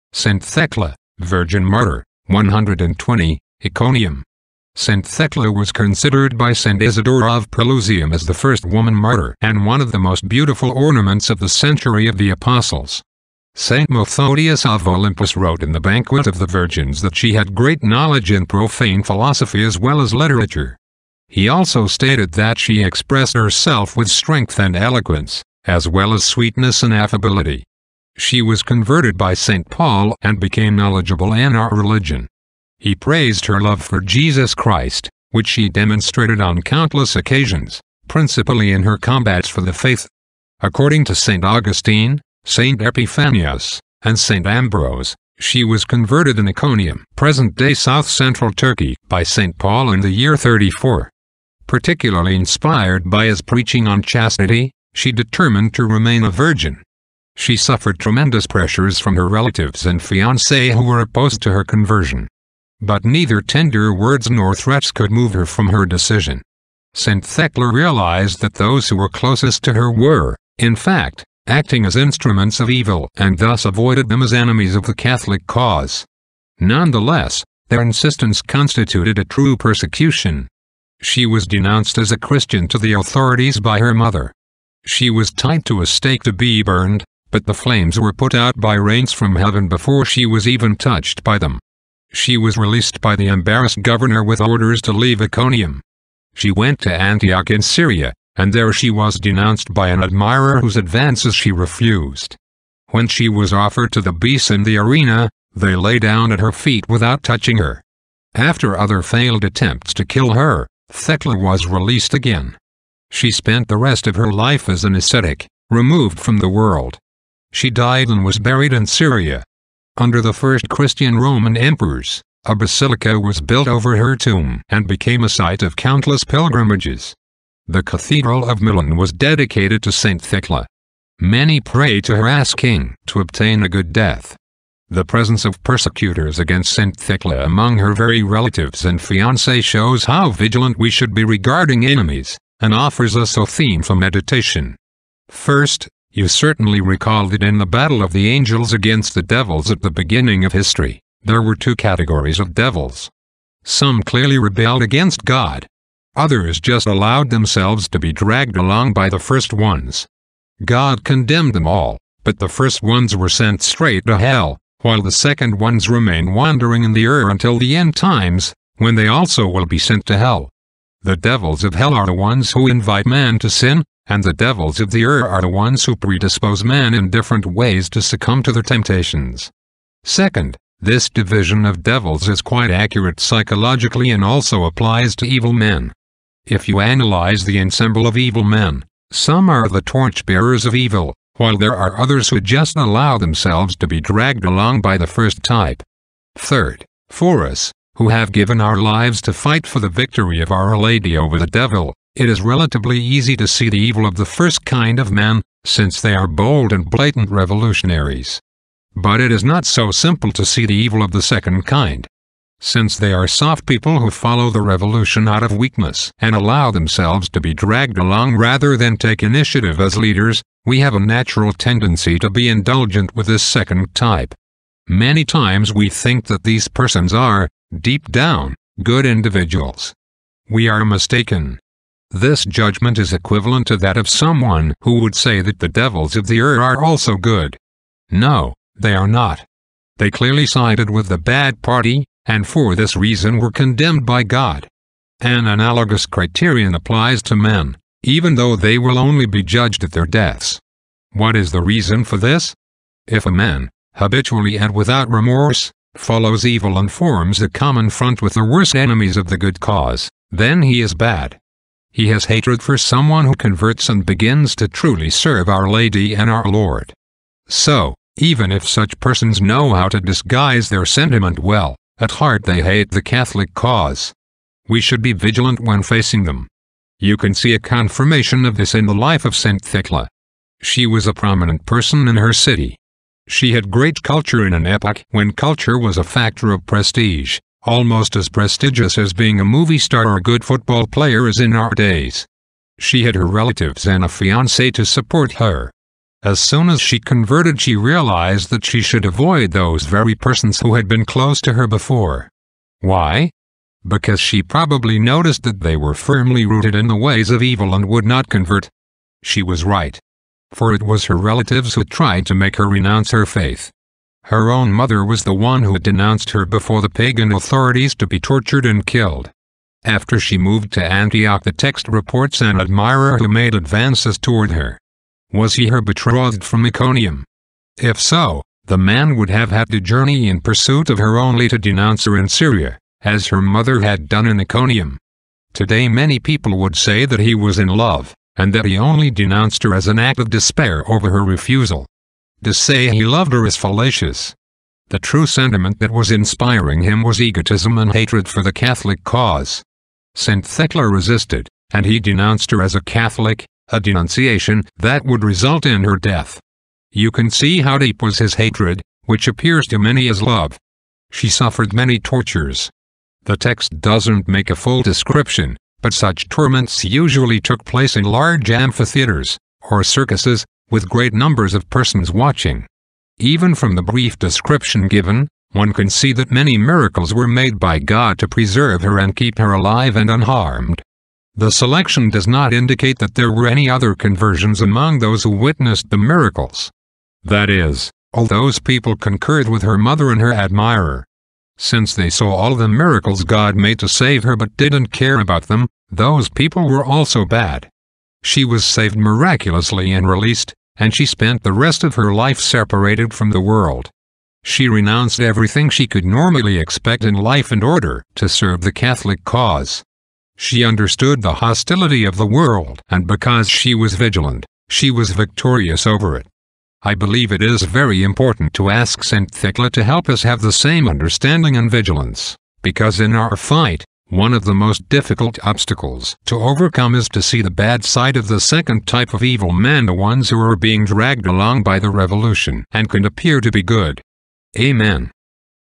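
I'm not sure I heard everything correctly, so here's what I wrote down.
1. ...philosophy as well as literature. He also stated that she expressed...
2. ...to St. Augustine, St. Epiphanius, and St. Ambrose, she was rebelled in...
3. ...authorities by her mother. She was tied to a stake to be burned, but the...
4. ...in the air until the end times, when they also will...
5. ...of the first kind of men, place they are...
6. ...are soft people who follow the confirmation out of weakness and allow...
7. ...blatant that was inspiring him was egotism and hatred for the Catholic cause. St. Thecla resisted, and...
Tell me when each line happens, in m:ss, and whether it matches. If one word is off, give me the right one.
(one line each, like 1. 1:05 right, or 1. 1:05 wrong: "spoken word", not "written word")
1. 0:19 right
2. 0:41 wrong: "converted", not "rebelled"
3. 1:22 right
4. 2:46 right
5. 3:24 wrong: "since", not "place"
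6. 3:33 wrong: "revolution", not "confirmation"
7. 5:45 wrong: "sentiment", not "blatant".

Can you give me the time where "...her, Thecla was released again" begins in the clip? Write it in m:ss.
1:50.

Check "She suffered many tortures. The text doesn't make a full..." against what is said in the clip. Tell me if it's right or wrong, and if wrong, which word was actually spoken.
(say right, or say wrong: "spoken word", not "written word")
right.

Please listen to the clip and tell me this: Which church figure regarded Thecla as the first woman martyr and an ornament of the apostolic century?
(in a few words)
St. Isidore of Pelusium.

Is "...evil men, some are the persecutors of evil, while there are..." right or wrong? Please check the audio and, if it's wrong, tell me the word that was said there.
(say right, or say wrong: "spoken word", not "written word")
wrong: "torchbearers", not "persecutors".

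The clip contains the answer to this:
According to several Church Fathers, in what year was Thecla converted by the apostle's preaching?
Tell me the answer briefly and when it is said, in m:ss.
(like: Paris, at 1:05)
34, at 0:50.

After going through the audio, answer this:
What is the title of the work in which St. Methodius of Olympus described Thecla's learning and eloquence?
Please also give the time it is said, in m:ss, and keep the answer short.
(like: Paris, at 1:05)
Banquet of the Virgins, at 0:15.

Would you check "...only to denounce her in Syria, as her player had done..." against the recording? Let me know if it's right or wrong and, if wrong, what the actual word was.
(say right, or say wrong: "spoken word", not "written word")
wrong: "mother", not "player".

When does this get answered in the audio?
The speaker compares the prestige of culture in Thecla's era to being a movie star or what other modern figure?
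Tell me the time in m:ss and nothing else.
4:50.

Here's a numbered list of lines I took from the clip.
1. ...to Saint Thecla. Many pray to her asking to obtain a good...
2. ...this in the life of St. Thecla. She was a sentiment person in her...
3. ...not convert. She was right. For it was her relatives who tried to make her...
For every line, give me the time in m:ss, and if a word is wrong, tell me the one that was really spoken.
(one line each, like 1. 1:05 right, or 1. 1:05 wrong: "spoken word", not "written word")
1. 2:09 right
2. 4:38 wrong: "prominent", not "sentiment"
3. 5:08 right.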